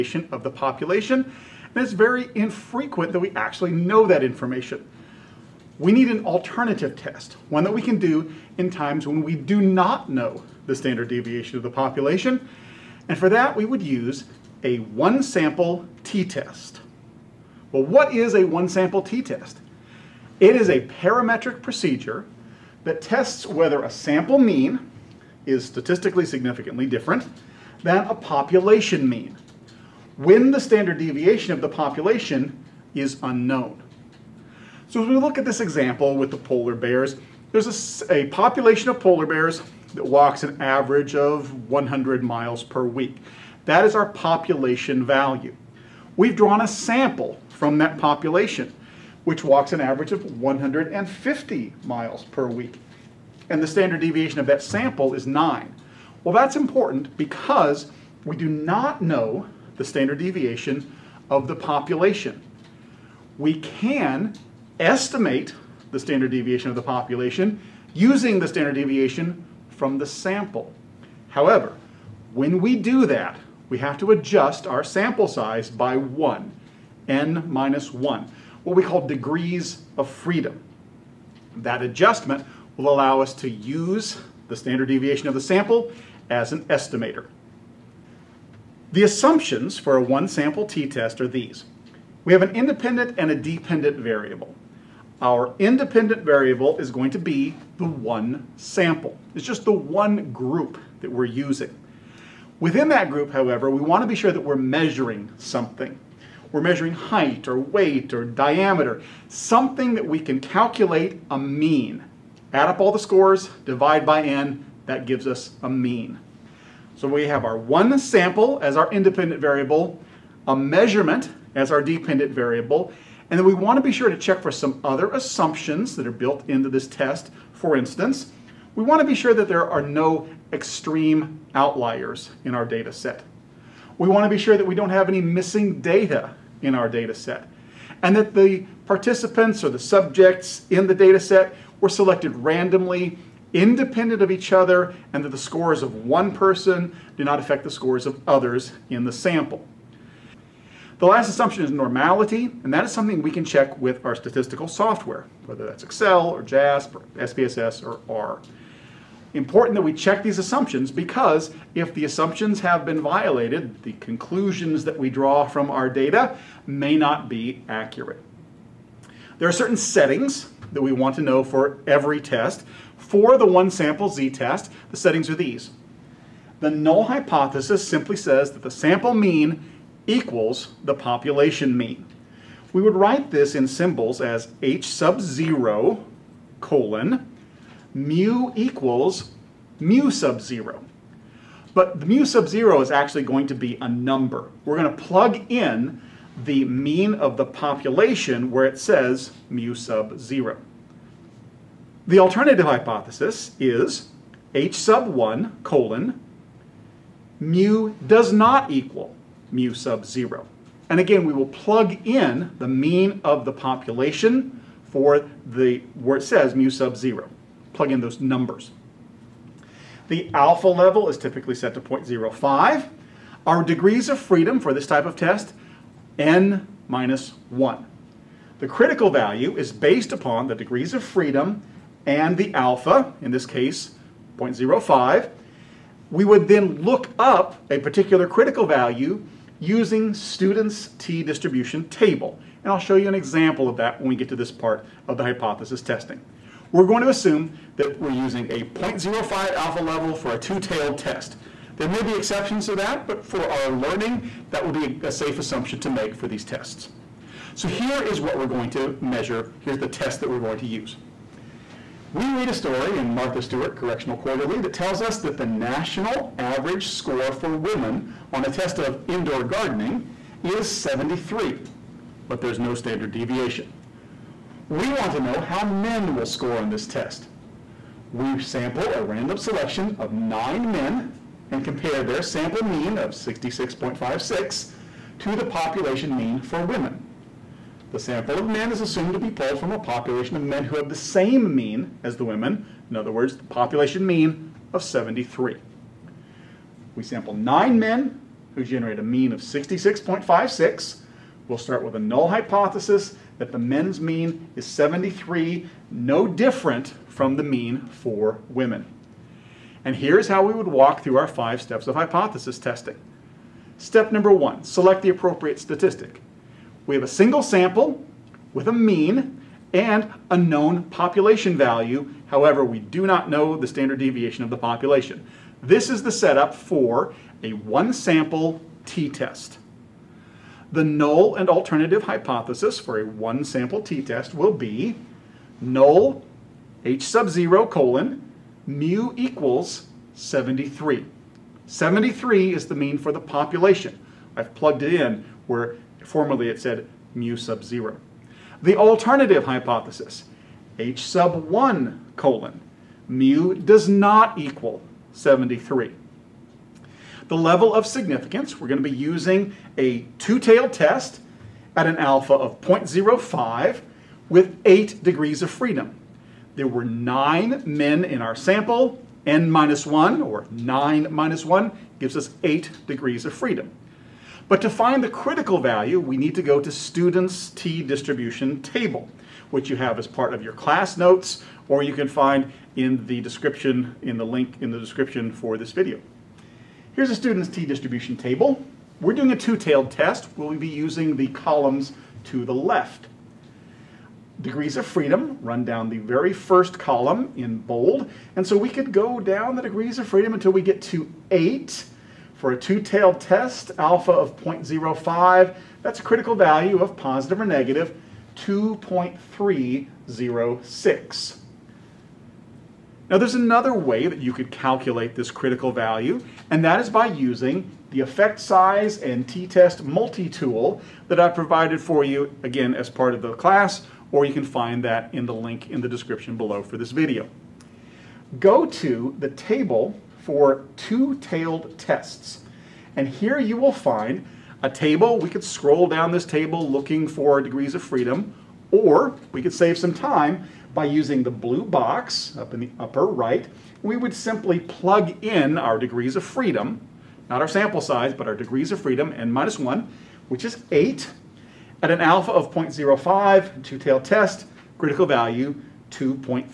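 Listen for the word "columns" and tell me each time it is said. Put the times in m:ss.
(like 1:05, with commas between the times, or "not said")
6:31, 6:36.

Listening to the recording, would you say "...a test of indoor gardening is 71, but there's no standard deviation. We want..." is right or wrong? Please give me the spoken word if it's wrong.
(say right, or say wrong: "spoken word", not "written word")
wrong: "73", not "71".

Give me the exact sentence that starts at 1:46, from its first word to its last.
We're measuring height or weight or diameter, something that we can calculate a mean.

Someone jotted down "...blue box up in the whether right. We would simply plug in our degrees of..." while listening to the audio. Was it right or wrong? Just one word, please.
wrong.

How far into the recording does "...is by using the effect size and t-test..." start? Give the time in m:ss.
6:56.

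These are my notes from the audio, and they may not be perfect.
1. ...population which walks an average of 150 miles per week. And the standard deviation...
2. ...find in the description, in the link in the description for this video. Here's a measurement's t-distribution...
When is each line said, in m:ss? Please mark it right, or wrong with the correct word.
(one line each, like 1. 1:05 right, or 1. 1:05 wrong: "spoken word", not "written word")
1. 0:47 right
2. 6:22 wrong: "student", not "measurement".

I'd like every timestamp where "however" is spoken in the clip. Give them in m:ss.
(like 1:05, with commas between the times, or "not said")
1:11, 1:43, 5:22.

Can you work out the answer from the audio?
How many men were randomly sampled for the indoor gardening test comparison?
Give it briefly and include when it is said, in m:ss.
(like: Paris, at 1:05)
9, at 6:06.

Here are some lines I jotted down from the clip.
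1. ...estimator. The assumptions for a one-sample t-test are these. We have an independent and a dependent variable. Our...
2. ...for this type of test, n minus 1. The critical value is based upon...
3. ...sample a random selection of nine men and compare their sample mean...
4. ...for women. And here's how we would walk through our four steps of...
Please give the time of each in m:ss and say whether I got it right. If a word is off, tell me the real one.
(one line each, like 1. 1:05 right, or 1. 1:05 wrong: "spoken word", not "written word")
1. 1:26 right
2. 3:44 right
3. 4:38 right
4. 5:07 wrong: "five", not "four".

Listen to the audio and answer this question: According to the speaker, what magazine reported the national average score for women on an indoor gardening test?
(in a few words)
Martha Stewart Correctional Quarterly.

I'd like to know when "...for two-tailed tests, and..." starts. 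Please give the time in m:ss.
7:10.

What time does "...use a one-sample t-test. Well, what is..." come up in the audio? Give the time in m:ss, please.
0:13.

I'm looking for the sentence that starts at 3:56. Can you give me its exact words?
We would then look up a particular critical value using students' t-distribution table.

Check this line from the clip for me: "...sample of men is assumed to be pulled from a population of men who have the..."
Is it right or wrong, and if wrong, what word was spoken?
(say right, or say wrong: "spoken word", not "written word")
right.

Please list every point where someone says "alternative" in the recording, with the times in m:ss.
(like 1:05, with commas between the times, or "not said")
0:06, 3:22, 5:31, 5:48.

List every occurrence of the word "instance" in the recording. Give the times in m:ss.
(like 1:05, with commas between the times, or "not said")
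2:07.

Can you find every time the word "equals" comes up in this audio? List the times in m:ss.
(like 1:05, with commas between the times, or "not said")
3:00, 3:08, 3:28, 5:39, 5:54.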